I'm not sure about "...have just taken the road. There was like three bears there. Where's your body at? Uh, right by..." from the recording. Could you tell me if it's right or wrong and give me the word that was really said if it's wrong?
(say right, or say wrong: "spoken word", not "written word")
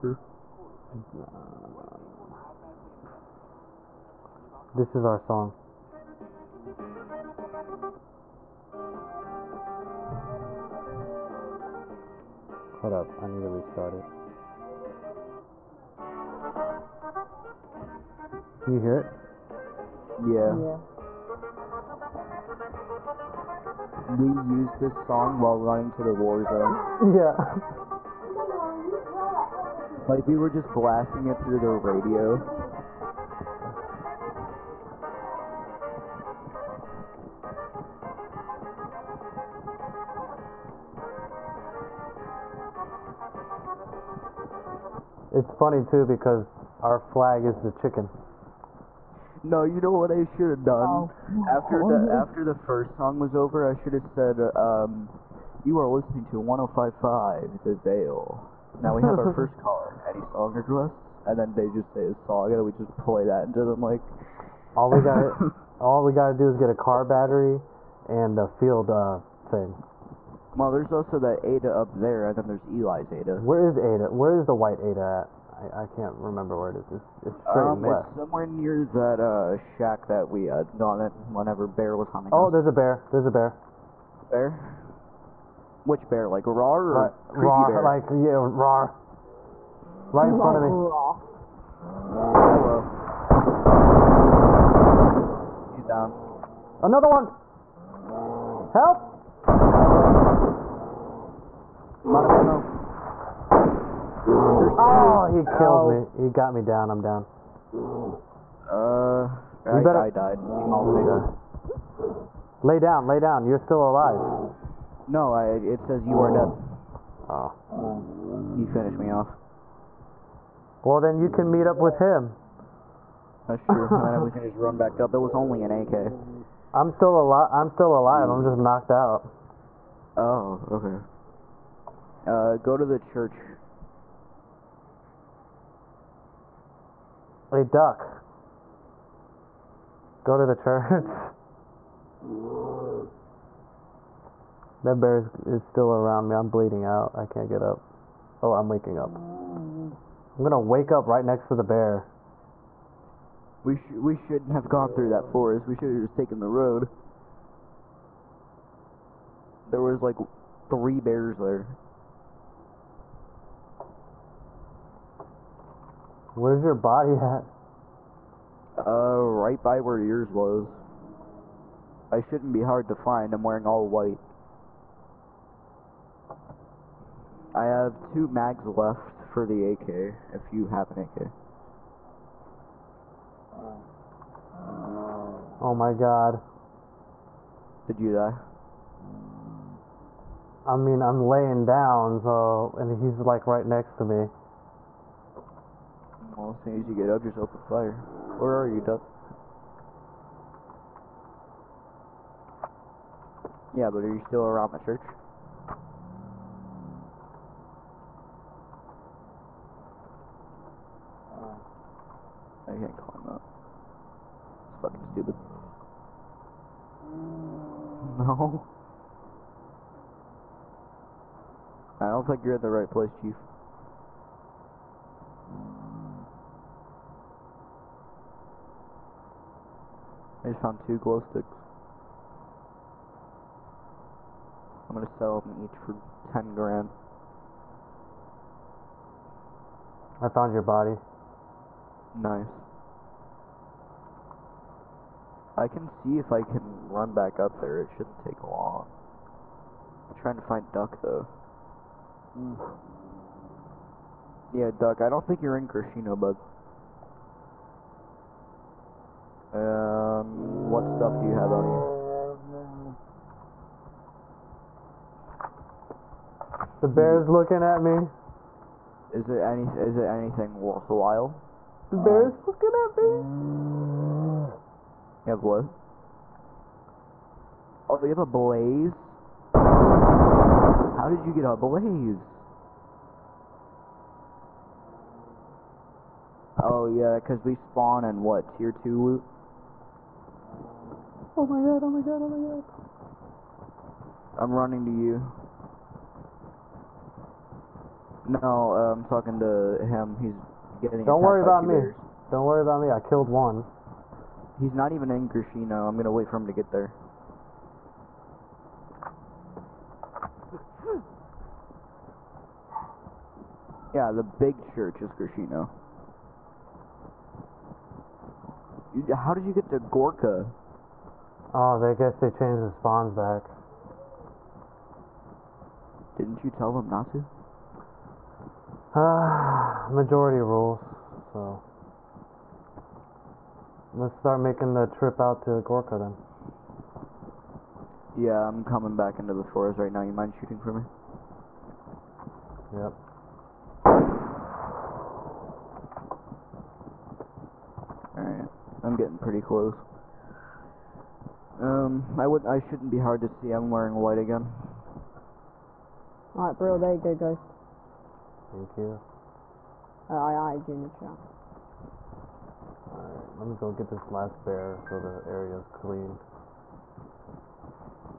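right.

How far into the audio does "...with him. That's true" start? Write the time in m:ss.
2:01.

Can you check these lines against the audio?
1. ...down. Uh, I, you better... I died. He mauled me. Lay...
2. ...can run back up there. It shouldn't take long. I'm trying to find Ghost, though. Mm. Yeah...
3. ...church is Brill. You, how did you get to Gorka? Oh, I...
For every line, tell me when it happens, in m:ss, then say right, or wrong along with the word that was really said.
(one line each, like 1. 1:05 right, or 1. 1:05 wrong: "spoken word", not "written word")
1. 1:47 right
2. 4:06 wrong: "Duck", not "Ghost"
3. 5:14 wrong: "Grishino", not "Brill".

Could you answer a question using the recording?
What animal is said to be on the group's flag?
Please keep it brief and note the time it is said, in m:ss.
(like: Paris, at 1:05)
Chicken, at 0:47.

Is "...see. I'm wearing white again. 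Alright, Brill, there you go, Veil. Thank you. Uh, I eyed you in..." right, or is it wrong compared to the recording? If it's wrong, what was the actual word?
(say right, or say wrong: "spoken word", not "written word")
wrong: "Ghost", not "Veil".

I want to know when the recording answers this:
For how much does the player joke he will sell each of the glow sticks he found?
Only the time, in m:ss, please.
3:56.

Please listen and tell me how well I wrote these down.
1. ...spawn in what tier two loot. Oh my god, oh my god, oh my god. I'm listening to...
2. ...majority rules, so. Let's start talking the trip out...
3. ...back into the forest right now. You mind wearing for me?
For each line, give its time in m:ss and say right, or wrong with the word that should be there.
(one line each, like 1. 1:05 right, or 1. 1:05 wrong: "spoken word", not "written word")
1. 4:47 wrong: "running", not "listening"
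2. 5:29 wrong: "making", not "talking"
3. 5:38 wrong: "shooting", not "wearing".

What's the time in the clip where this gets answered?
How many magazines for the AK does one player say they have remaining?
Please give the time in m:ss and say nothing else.
2:58.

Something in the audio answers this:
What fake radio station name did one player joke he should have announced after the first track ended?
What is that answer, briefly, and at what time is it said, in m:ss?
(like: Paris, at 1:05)
105.5 The Veil, at 0:56.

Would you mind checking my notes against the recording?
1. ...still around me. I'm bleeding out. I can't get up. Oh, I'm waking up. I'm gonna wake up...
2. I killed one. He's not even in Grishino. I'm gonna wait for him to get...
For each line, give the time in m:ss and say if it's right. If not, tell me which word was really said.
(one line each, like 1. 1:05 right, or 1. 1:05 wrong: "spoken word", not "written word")
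1. 2:25 right
2. 5:02 right.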